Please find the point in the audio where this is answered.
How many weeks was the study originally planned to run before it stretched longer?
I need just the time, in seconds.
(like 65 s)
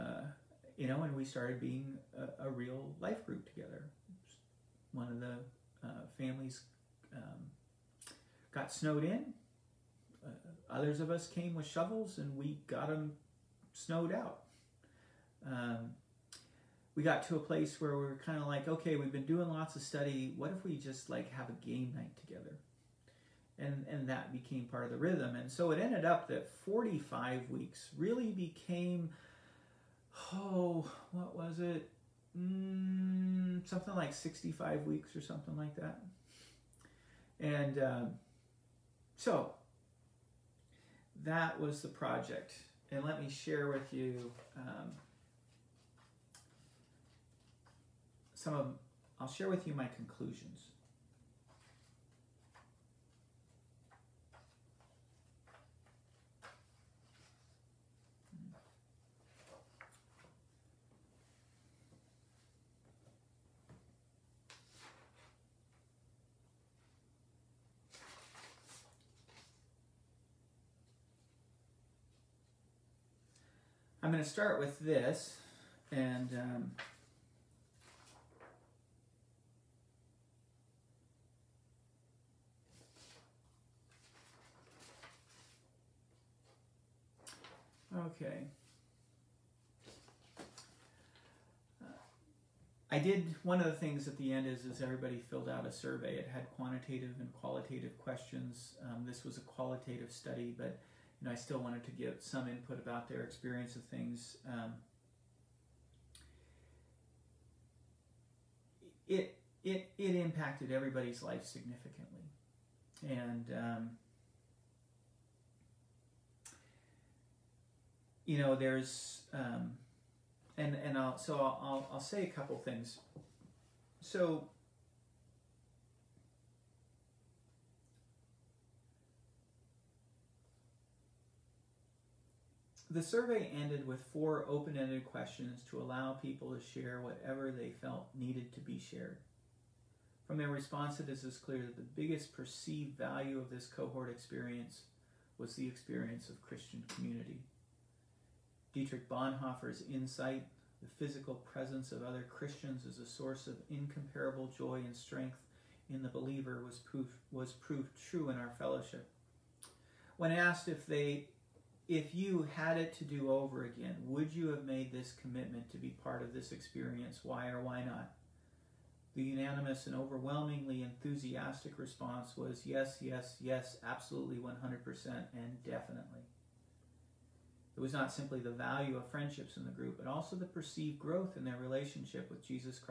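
26 s.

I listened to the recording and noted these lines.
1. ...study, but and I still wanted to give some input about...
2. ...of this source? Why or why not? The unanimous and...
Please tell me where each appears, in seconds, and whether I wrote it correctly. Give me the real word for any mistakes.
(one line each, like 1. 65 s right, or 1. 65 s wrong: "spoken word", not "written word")
1. 100 s right
2. 166 s wrong: "experience", not "source".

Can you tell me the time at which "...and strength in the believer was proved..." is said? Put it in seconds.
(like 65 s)
154 s.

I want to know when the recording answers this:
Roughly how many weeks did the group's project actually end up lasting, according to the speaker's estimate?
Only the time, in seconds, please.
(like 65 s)
34 s.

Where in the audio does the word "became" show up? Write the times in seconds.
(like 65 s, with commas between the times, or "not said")
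24 s, 28 s.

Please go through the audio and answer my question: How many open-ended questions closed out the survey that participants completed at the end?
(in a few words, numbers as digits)
4.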